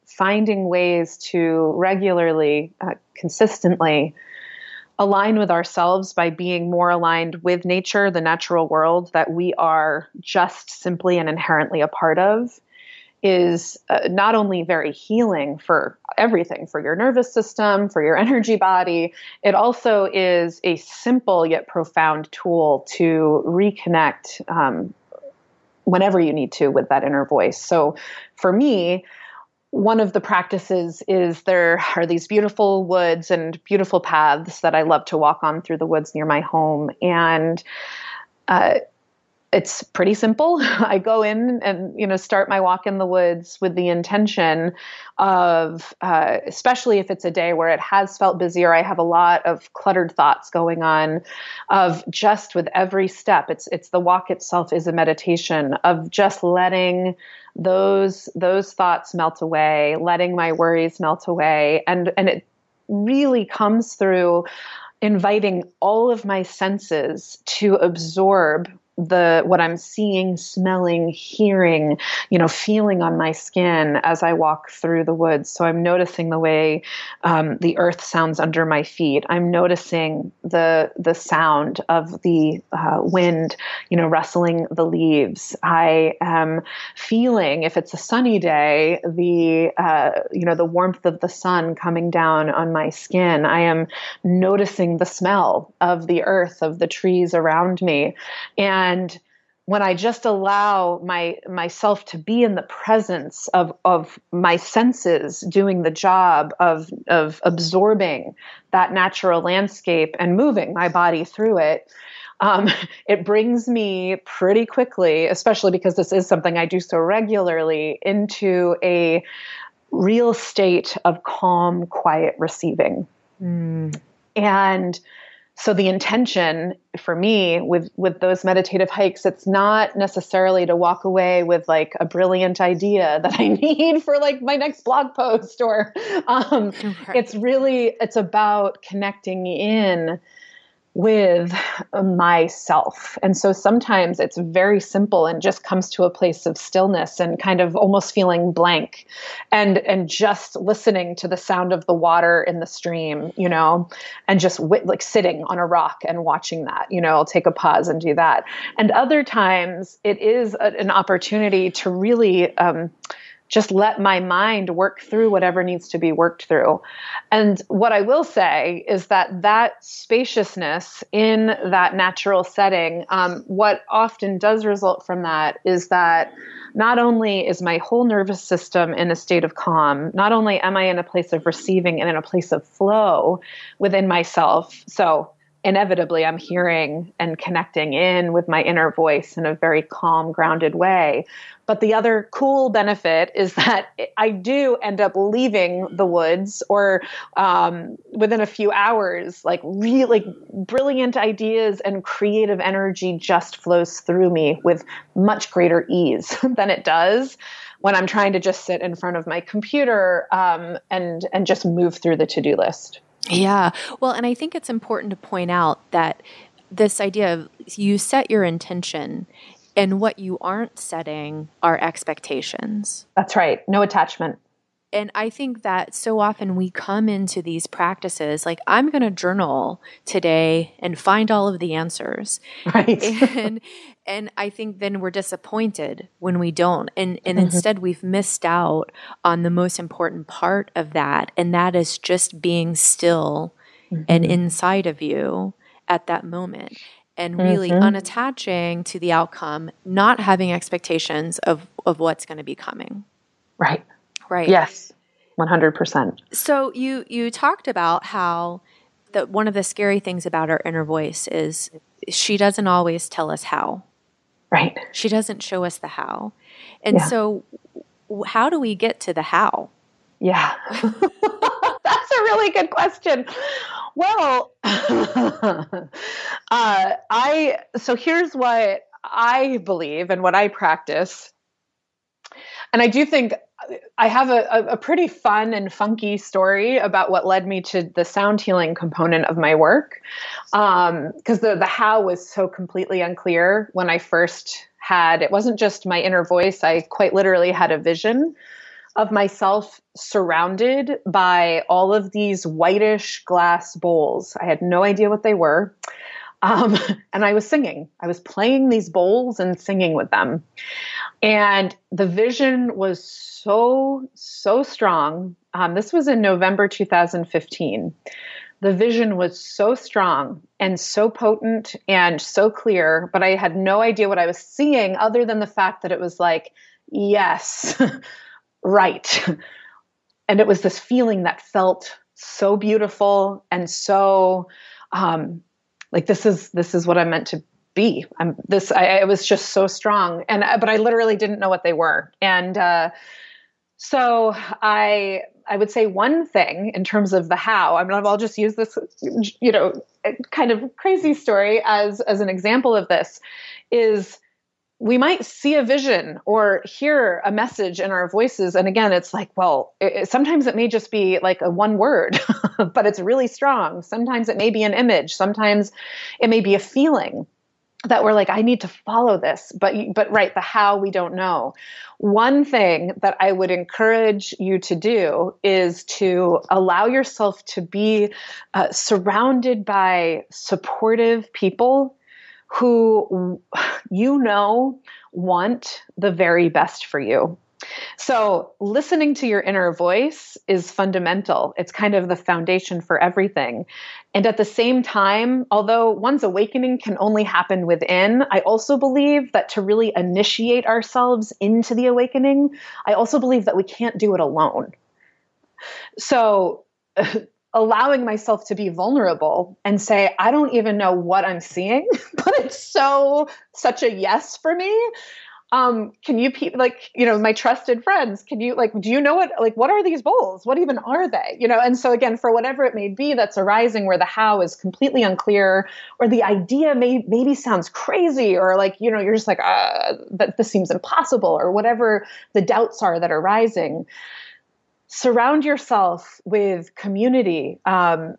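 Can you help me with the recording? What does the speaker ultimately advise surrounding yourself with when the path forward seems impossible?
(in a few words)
Community.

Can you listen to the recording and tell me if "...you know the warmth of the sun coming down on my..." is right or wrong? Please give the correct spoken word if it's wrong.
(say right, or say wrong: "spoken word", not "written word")
right.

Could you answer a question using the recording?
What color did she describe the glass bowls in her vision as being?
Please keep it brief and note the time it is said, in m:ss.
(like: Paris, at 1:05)
Whitish, at 5:02.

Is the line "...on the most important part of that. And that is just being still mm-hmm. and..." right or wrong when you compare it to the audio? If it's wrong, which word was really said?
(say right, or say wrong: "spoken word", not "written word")
right.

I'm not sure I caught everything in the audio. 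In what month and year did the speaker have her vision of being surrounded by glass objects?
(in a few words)
November 2015.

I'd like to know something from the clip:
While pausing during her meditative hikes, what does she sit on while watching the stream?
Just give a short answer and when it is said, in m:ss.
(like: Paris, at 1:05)
A rock, at 2:35.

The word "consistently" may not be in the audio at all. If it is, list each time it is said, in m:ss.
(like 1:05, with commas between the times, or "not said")
0:03.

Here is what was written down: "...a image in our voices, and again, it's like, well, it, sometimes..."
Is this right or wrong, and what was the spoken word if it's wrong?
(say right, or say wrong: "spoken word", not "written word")
wrong: "message", not "image".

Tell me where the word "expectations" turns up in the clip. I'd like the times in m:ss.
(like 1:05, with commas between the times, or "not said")
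3:41, 4:10.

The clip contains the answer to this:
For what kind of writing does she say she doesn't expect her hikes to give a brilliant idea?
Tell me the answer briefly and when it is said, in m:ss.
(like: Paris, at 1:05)
Next blog post, at 2:14.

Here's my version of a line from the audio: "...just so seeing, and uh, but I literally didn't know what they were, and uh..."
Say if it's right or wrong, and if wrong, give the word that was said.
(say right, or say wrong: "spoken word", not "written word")
wrong: "strong", not "seeing".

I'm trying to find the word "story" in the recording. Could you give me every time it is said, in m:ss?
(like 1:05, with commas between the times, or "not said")
4:46, 5:51.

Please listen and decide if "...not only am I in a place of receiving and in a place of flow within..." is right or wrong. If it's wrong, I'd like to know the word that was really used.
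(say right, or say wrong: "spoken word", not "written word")
right.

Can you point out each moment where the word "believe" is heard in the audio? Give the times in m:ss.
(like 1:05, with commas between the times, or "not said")
4:39, 6:38, 6:43.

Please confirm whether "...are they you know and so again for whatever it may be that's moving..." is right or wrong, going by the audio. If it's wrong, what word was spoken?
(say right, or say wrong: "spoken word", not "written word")
wrong: "arising", not "moving".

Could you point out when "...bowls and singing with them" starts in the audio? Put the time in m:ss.
5:08.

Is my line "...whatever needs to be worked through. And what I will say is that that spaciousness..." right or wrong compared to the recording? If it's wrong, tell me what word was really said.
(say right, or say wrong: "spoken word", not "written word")
right.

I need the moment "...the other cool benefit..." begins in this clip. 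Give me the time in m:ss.
3:11.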